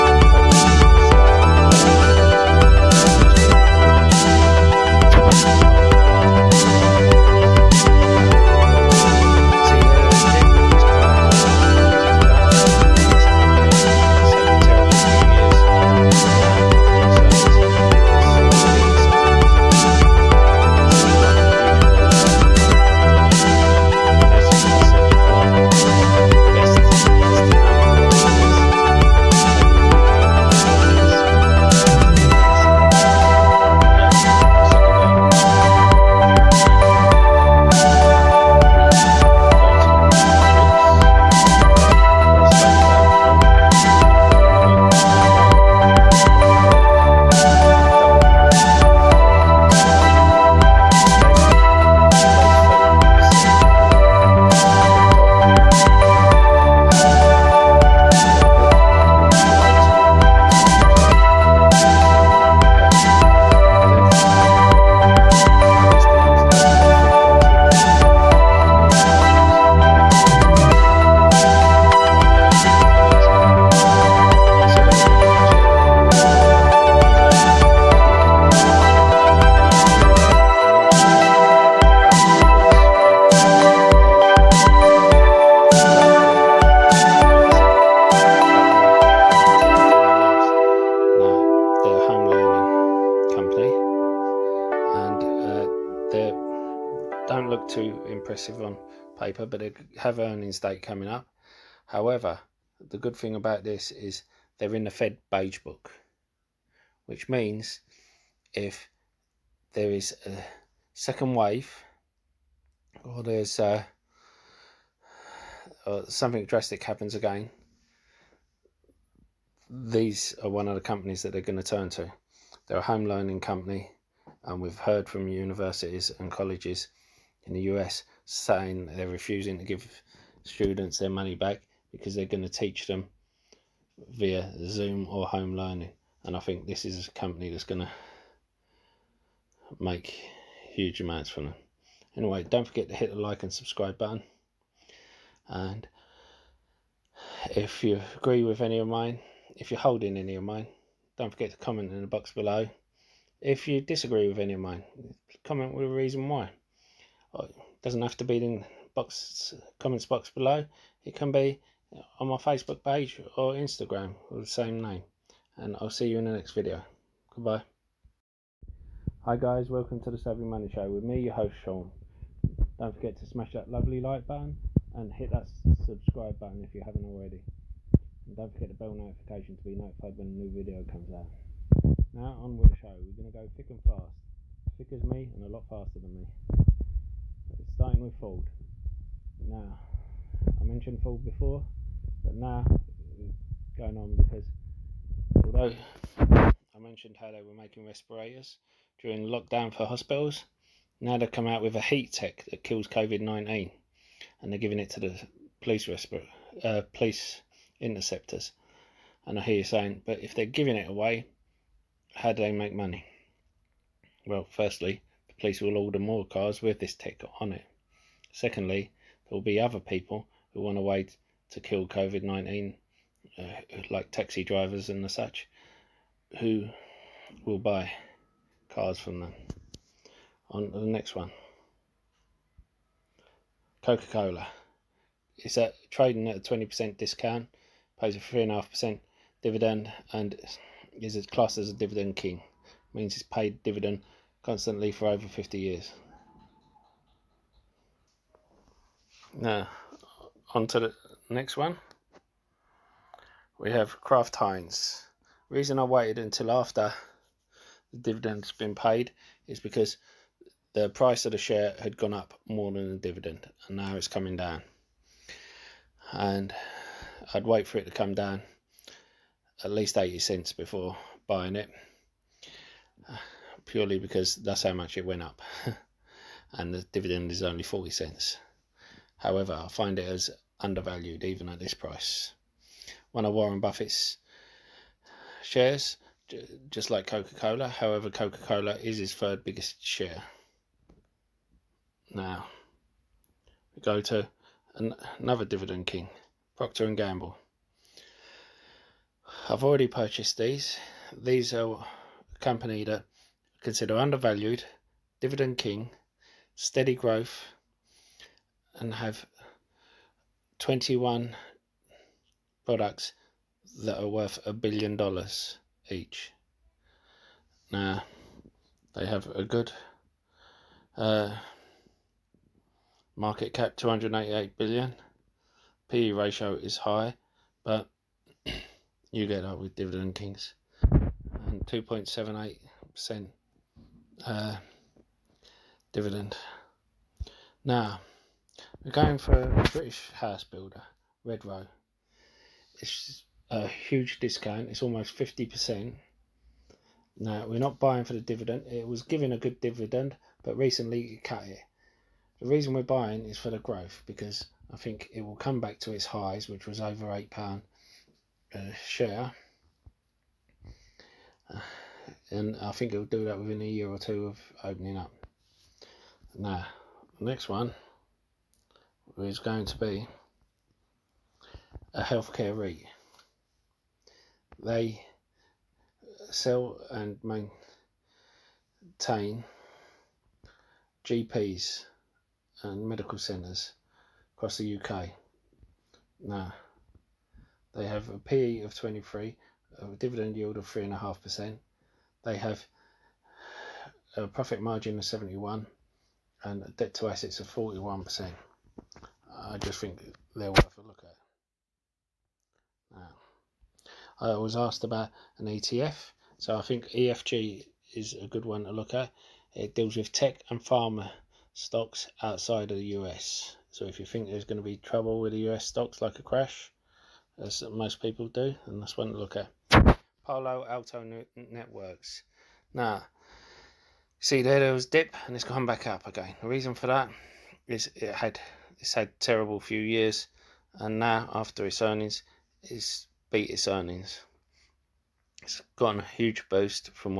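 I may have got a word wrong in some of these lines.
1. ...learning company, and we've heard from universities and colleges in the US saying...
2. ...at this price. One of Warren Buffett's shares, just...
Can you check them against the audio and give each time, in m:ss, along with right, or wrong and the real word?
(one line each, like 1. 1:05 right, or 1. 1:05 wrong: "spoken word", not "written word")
1. 2:03 right
2. 4:41 right.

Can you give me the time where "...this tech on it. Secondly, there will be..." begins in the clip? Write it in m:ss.
3:36.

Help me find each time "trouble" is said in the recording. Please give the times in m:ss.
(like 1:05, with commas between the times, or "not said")
6:54.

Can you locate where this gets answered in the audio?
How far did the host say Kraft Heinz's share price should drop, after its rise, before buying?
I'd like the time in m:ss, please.
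4:29.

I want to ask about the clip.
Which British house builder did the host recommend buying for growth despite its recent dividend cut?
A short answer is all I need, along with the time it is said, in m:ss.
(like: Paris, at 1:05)
Redrow, at 5:41.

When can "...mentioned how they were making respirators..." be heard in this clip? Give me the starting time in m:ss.
3:16.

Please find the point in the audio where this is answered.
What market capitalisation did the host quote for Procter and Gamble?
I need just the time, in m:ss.
5:23.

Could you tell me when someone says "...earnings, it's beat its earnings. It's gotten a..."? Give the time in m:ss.
7:11.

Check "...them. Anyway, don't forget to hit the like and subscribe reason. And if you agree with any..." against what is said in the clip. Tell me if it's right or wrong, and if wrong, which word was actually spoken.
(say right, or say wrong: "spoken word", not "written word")
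wrong: "button", not "reason".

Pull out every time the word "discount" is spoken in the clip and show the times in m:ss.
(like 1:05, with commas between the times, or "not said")
3:56, 5:44.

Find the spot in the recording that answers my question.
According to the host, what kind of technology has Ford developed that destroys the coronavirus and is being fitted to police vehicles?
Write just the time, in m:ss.
3:21.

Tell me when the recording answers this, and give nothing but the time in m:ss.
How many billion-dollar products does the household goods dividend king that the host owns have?
5:10.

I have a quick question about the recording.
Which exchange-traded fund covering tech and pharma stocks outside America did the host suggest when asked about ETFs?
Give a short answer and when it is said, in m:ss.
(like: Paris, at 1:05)
EFG, at 6:46.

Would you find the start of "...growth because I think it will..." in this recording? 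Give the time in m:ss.
5:53.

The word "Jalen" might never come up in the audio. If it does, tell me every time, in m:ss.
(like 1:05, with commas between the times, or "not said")
not said.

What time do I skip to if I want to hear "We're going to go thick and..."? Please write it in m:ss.
3:03.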